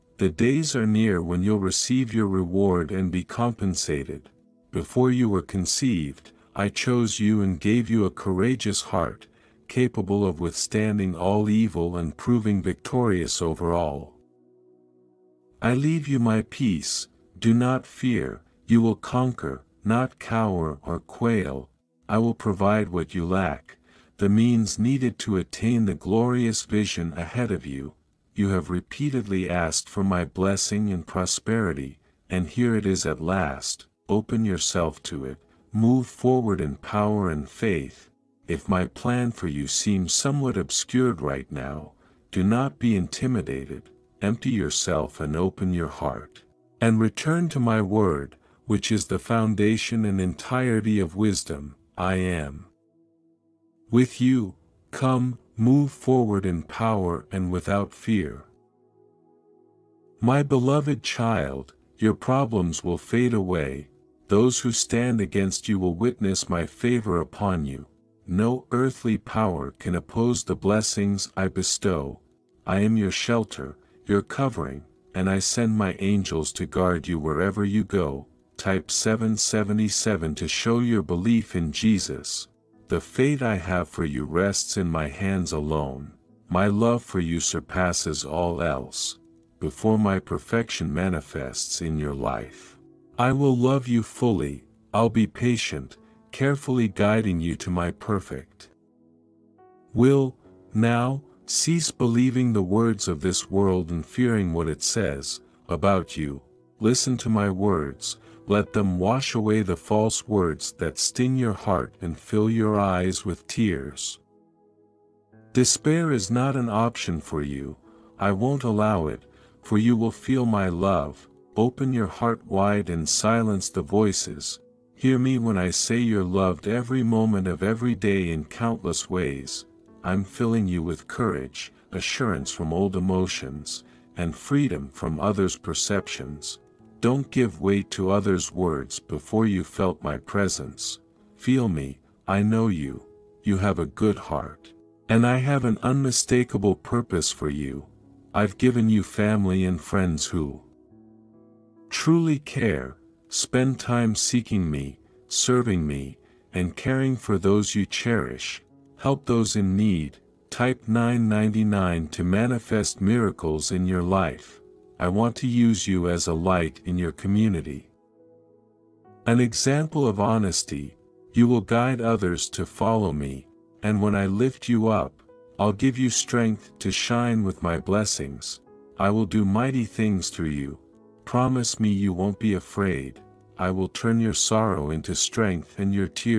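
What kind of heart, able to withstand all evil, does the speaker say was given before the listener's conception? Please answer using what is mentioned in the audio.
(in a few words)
courageous heart.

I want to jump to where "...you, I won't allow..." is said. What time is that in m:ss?
1:57.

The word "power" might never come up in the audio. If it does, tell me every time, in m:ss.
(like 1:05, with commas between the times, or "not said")
0:36, 0:56, 1:09.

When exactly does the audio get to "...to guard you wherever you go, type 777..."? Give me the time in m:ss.
1:16.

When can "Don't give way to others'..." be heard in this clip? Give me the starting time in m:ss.
2:17.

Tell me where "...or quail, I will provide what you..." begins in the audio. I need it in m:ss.
0:20.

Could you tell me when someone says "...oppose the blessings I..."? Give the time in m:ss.
1:09.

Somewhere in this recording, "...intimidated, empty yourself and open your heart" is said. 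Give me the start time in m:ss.
0:42.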